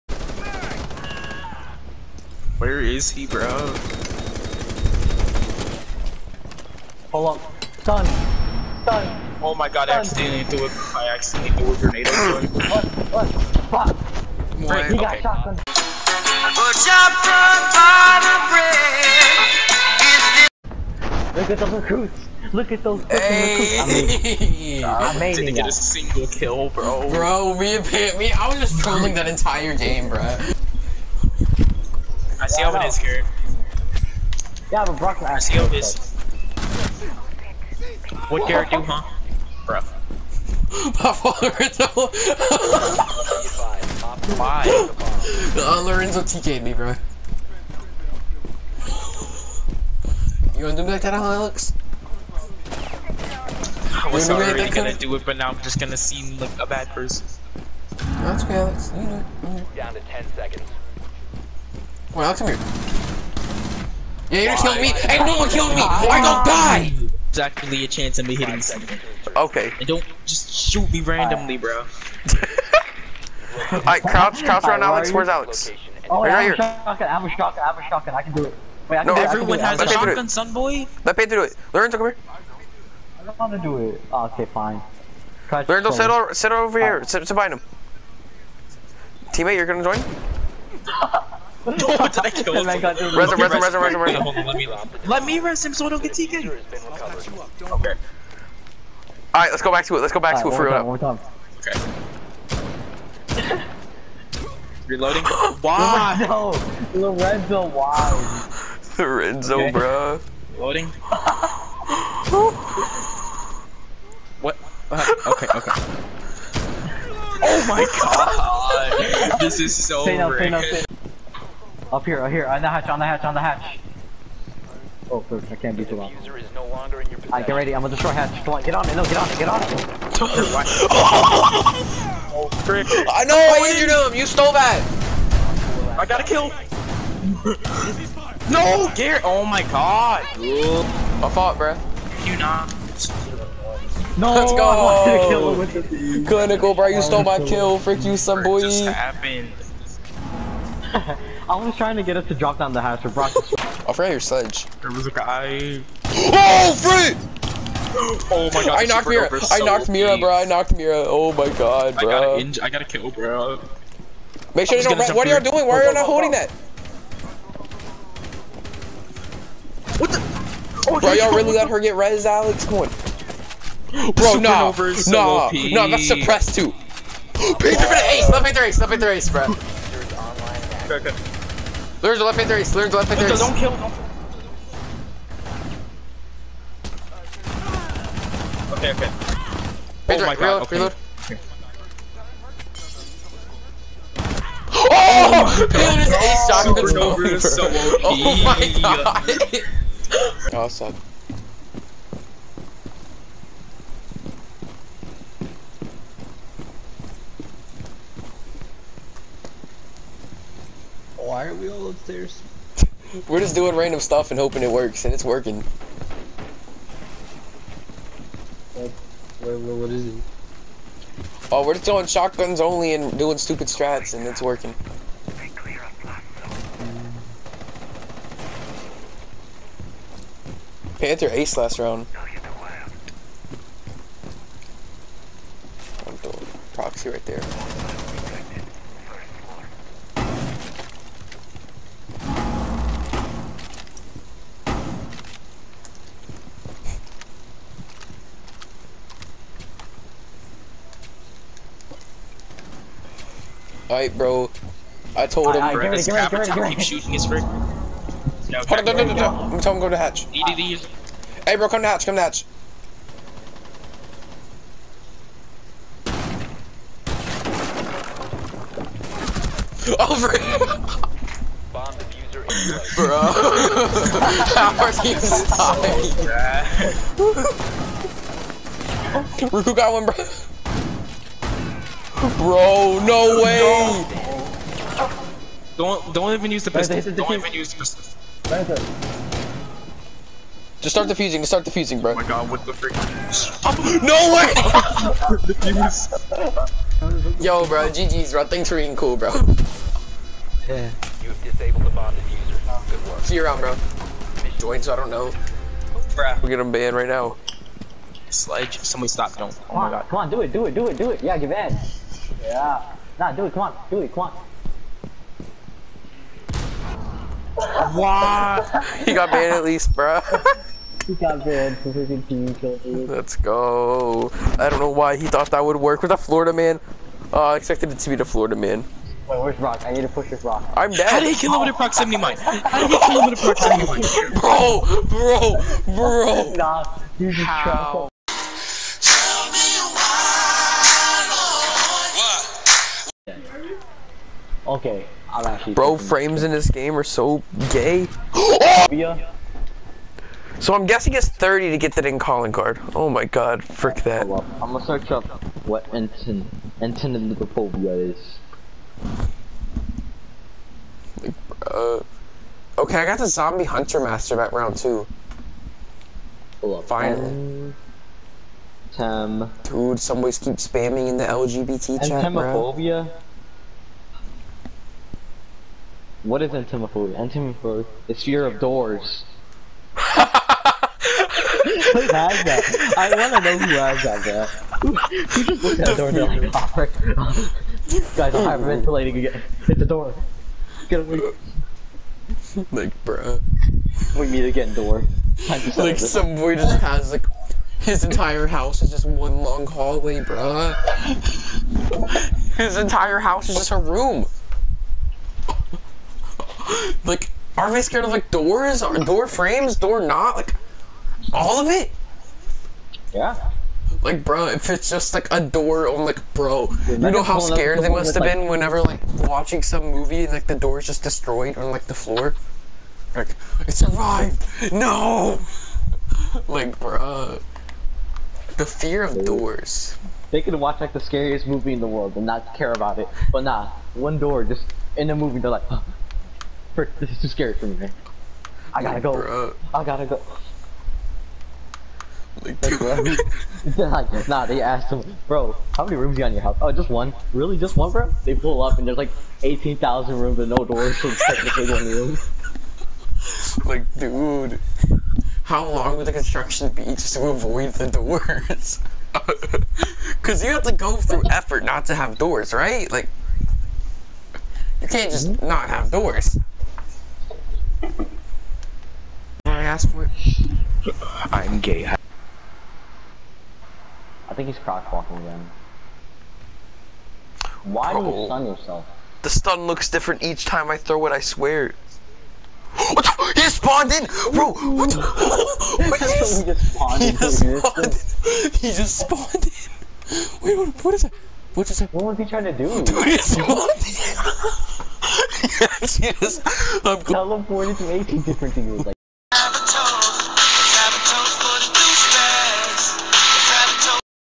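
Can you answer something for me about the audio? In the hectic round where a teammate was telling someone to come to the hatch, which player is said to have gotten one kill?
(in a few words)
Ruku.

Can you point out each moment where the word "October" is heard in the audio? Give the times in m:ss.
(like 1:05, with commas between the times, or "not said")
not said.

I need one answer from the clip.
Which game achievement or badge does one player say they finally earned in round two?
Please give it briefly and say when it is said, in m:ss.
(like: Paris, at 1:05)
Zombie hunter master, at 6:03.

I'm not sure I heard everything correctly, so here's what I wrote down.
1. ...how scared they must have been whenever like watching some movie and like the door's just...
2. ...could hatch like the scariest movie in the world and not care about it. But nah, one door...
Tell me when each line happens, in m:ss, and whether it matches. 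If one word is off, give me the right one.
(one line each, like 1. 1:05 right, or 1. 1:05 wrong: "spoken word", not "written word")
1. 6:57 right
2. 7:10 wrong: "watch", not "hatch".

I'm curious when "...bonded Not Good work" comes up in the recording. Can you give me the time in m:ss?
5:01.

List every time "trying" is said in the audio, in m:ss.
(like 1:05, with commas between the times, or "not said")
2:31, 8:12.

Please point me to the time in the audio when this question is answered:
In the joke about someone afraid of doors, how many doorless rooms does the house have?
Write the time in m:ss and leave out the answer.
7:29.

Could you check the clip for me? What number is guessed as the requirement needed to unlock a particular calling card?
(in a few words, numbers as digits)
30.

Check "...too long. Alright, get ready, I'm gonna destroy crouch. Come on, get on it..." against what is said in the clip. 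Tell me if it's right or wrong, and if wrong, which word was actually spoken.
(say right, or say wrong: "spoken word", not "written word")
wrong: "hatch", not "crouch".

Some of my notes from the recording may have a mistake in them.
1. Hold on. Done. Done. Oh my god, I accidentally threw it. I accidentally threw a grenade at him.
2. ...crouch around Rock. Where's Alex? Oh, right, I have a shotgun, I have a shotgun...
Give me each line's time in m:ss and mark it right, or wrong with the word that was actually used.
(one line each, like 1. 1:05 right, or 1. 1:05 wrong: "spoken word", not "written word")
1. 0:07 right
2. 1:14 wrong: "Alex", not "Rock".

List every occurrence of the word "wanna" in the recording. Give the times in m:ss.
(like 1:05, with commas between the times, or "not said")
0:50, 6:23.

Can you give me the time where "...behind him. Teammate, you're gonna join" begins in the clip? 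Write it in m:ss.
1:27.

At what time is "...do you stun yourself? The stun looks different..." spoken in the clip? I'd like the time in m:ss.
7:58.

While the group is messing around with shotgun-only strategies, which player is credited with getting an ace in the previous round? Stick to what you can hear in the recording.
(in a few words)
Panther.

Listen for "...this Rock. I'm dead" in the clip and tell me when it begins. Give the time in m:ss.
5:30.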